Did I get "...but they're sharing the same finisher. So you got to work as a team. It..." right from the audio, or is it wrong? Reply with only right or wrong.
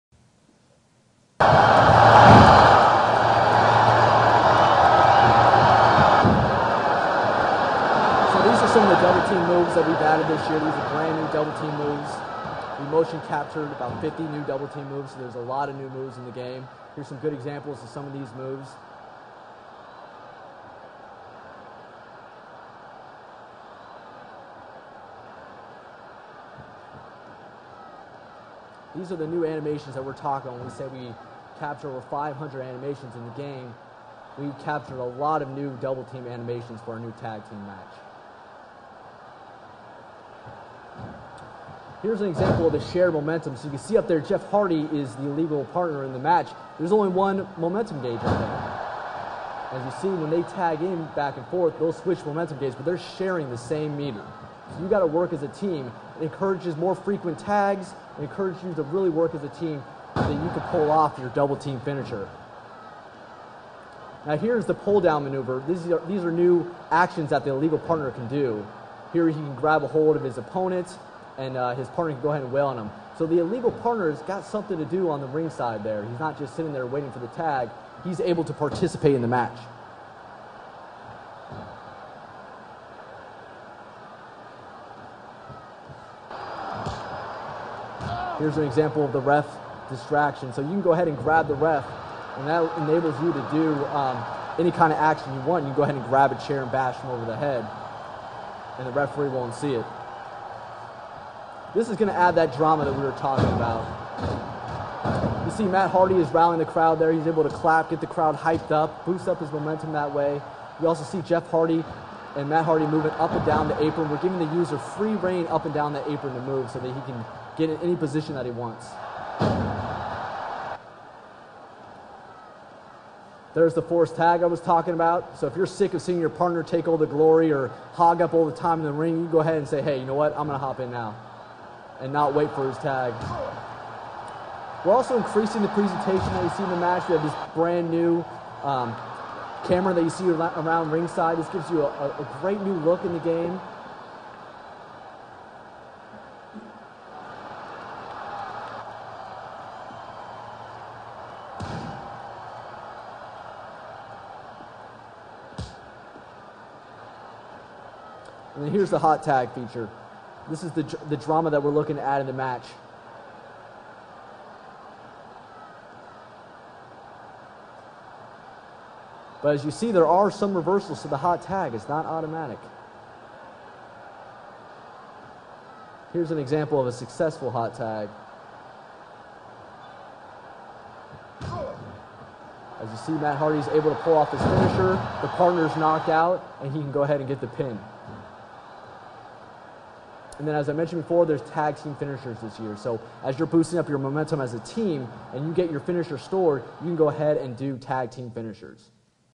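wrong.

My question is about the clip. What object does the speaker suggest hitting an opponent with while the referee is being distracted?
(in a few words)
a chair.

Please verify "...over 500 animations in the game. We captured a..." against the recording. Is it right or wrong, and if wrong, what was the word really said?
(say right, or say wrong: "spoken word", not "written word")
right.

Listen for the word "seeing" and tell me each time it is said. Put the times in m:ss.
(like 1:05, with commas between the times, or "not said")
2:06.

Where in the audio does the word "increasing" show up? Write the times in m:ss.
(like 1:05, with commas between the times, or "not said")
2:15.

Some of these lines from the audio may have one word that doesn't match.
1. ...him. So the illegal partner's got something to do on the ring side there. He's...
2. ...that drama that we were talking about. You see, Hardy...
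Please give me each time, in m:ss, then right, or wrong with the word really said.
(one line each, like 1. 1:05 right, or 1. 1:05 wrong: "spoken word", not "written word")
1. 1:12 right
2. 1:42 wrong: "Matt", not "Hardy".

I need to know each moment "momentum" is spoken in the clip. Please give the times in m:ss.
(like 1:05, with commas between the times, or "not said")
0:43, 0:47, 0:52, 1:49, 3:13.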